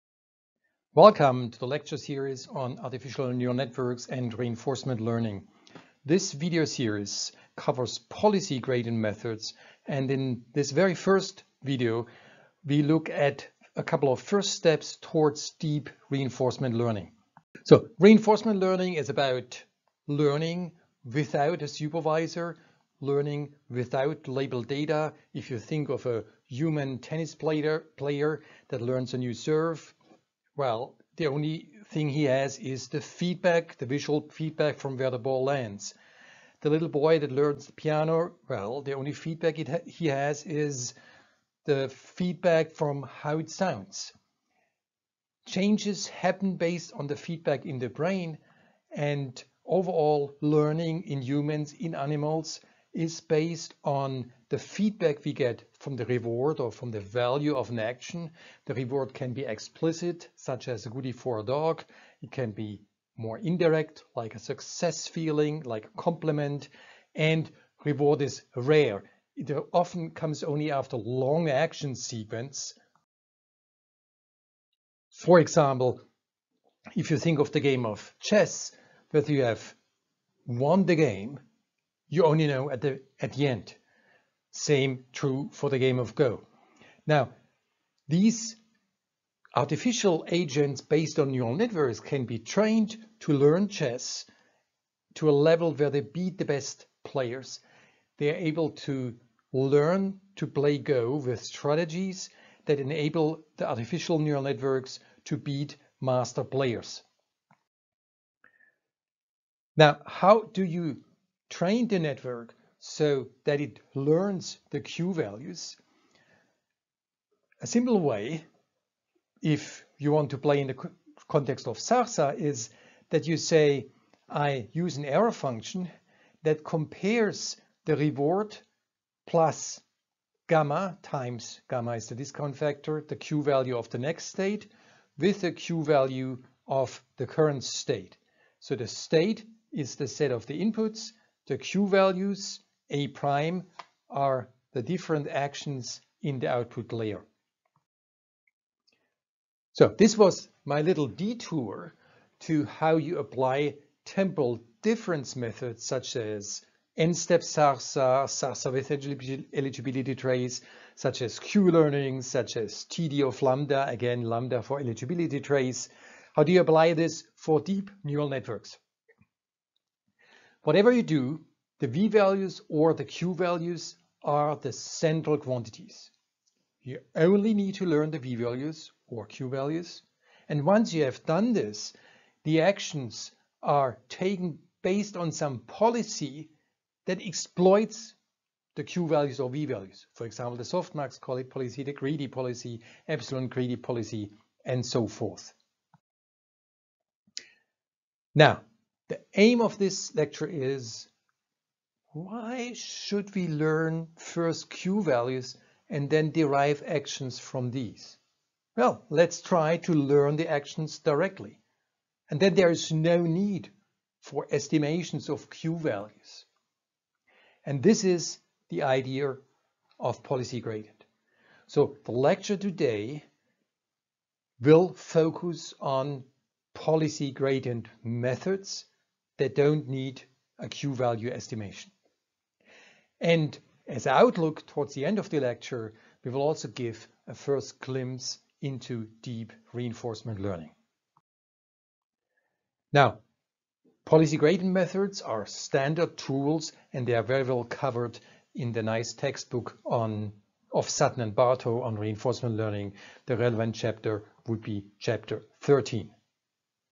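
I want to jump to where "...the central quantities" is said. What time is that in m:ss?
2:54.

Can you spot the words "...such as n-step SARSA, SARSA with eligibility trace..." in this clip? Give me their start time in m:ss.
2:35.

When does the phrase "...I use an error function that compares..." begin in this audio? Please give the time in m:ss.
2:04.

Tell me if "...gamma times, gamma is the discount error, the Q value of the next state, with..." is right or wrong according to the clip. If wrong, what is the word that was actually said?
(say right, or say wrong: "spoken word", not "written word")
wrong: "factor", not "error".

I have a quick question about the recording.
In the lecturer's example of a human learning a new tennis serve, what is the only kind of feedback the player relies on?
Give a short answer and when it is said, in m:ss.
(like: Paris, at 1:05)
Visual feedback, at 0:33.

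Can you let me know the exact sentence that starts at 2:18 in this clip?
So the state is the set of the inputs the Q values, A prime, are the different actions in the output layer.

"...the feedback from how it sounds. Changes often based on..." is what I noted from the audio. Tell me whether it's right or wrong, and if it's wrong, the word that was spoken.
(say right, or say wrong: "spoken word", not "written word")
wrong: "happen", not "often".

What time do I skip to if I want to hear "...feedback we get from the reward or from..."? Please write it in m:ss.
0:54.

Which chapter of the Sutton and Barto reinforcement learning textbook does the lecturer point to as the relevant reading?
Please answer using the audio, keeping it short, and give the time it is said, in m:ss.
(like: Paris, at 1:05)
Chapter 13, at 4:14.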